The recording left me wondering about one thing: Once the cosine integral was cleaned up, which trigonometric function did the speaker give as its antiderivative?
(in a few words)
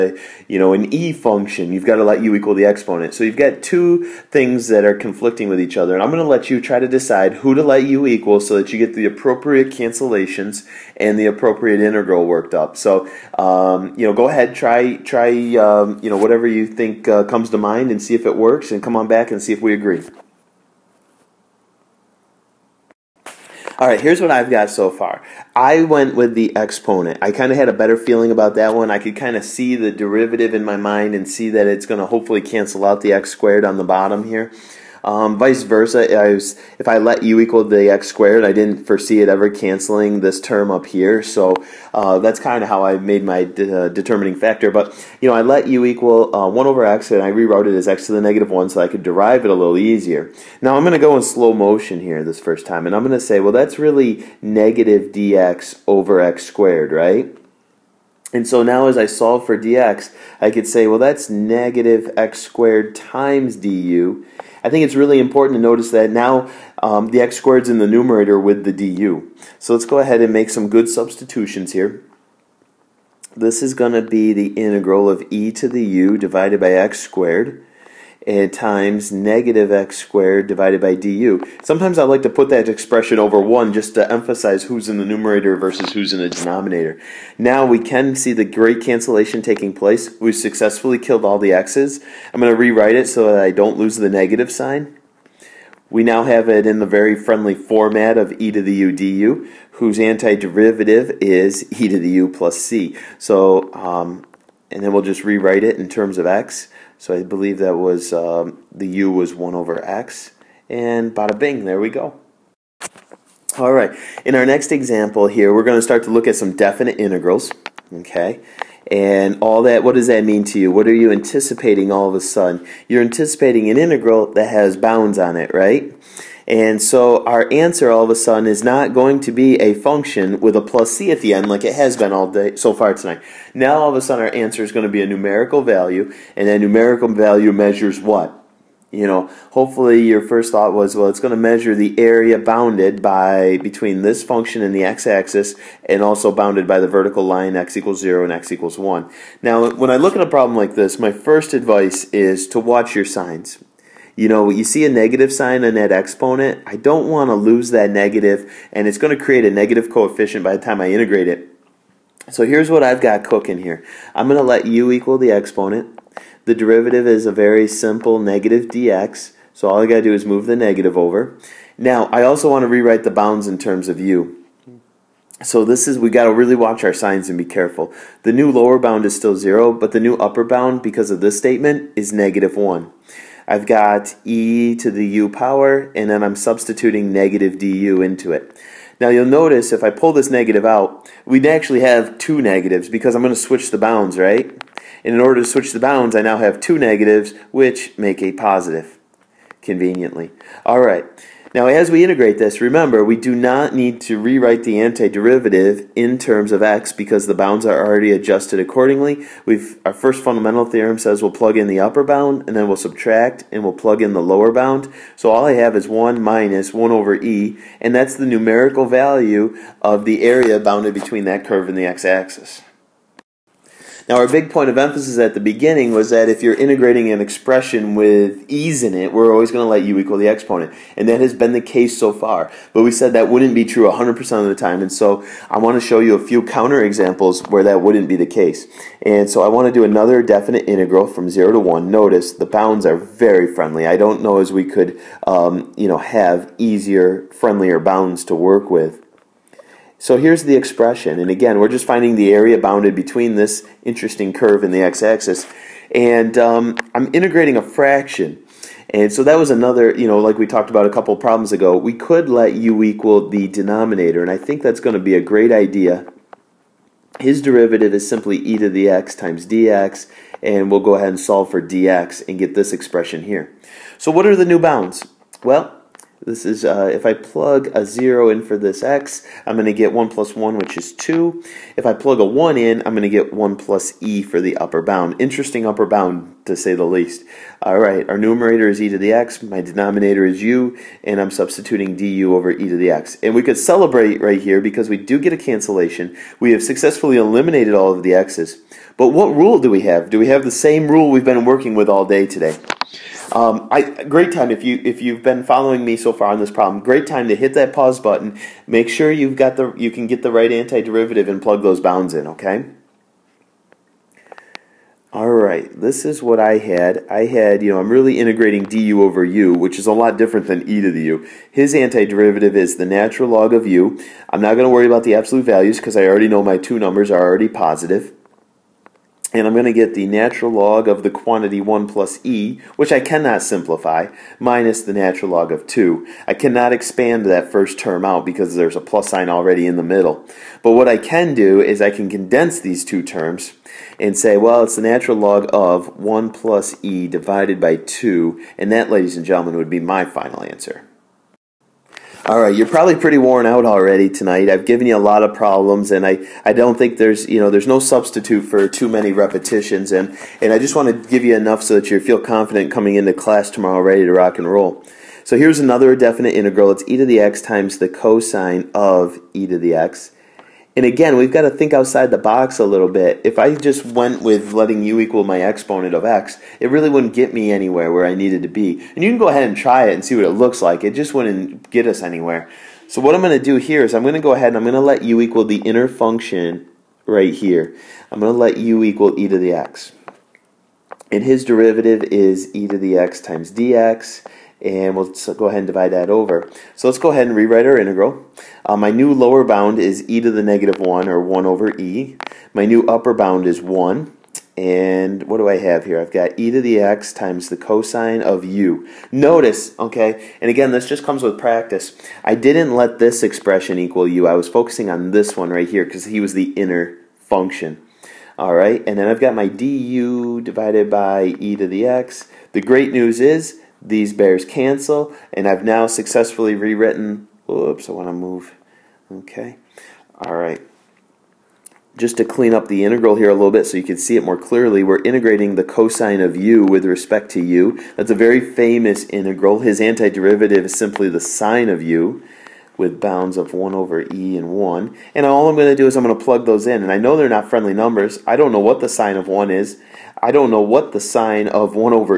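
sine of u.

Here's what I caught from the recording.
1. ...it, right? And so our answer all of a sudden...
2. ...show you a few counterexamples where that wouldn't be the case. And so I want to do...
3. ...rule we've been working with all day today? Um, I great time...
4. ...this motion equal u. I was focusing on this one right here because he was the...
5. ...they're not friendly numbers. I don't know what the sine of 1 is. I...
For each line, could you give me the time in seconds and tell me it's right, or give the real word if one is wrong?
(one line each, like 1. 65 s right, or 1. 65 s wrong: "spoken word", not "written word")
1. 125 s right
2. 235 s right
3. 300 s right
4. 412 s wrong: "expression", not "motion"
5. 447 s right.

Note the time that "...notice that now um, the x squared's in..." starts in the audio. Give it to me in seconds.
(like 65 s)
65 s.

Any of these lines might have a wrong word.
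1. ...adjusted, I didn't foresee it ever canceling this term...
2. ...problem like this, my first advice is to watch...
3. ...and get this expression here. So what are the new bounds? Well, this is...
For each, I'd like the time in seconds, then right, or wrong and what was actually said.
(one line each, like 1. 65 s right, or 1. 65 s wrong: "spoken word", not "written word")
1. 38 s wrong: "squared", not "adjusted"
2. 150 s right
3. 272 s right.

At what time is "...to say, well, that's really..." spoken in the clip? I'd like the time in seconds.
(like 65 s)
53 s.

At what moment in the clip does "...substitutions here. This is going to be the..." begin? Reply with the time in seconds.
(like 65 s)
70 s.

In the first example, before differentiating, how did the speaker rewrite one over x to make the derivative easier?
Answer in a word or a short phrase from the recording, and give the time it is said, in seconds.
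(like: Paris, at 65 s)
x to the -1, at 47 s.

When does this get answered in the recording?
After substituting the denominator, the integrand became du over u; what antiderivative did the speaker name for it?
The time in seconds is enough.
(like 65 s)
322 s.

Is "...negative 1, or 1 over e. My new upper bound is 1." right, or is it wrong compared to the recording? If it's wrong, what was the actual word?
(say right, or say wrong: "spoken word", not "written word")
right.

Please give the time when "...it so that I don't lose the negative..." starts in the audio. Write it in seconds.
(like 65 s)
92 s.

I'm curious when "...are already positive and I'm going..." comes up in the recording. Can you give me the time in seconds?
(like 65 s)
327 s.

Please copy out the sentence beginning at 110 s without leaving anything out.
And bada bing, there we go.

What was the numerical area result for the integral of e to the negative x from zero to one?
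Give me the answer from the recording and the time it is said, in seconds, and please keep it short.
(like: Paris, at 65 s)
1 minus 1 over e, at 215 s.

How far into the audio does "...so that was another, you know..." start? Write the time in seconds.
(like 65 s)
259 s.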